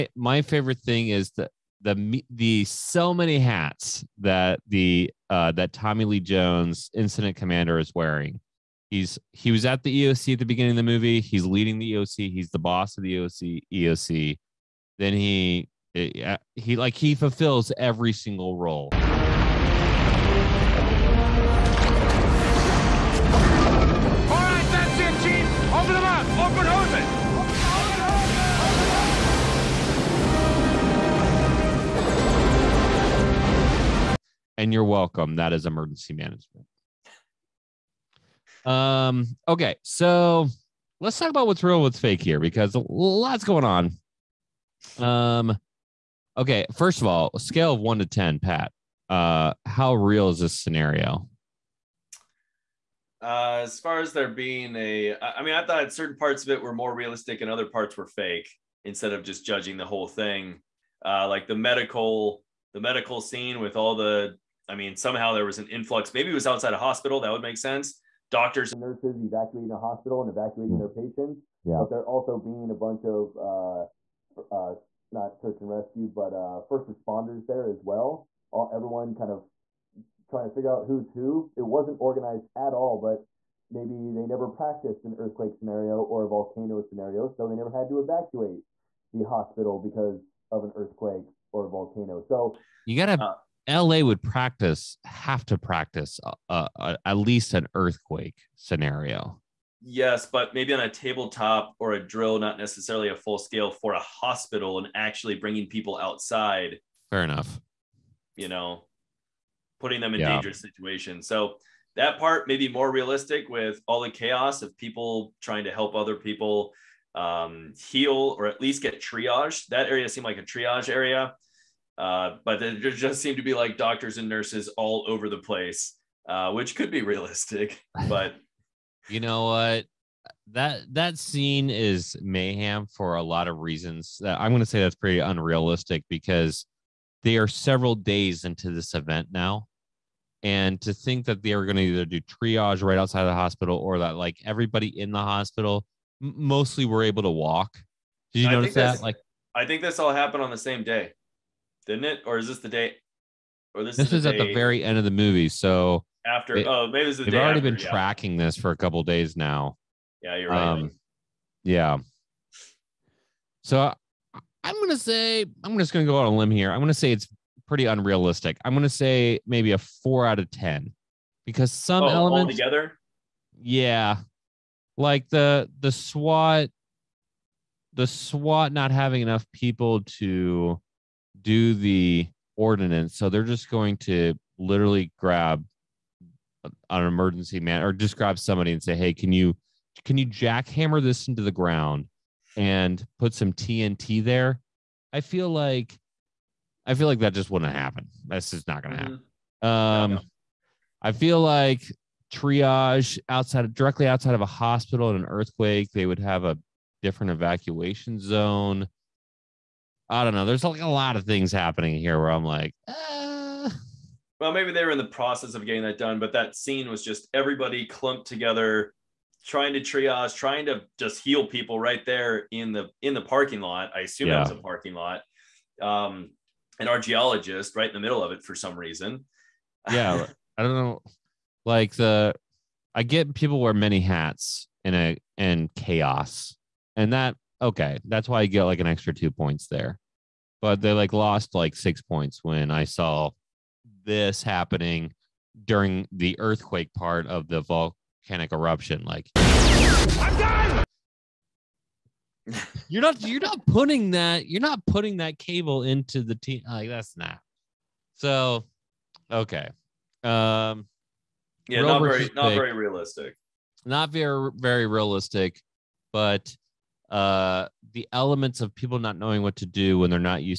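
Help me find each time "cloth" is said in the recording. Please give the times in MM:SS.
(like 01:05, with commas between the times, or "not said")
not said.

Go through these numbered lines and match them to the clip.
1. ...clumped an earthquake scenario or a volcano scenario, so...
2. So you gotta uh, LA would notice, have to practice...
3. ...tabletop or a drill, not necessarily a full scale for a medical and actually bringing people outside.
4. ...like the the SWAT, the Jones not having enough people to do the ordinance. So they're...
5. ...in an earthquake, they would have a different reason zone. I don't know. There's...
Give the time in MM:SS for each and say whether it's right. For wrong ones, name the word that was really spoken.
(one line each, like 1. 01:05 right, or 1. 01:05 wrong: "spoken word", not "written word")
1. 01:24 wrong: "practiced", not "clumped"
2. 01:32 wrong: "practice", not "notice"
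3. 01:40 wrong: "hospital", not "medical"
4. 02:54 wrong: "SWAT", not "Jones"
5. 03:25 wrong: "evacuation", not "reason".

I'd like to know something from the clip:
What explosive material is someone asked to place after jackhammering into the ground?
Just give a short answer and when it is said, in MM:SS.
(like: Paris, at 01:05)
TNT, at 03:13.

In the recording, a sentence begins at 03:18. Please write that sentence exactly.
That's just not going to happen.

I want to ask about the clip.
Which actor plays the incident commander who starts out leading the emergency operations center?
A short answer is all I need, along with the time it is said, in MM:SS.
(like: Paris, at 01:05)
Tommy Lee Jones, at 00:05.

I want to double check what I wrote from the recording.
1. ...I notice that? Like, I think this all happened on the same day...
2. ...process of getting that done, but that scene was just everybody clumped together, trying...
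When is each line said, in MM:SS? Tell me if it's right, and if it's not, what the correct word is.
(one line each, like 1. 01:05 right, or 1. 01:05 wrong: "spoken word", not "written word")
1. 02:28 right
2. 03:35 right.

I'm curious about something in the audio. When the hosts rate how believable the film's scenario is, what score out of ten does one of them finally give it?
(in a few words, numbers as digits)
4.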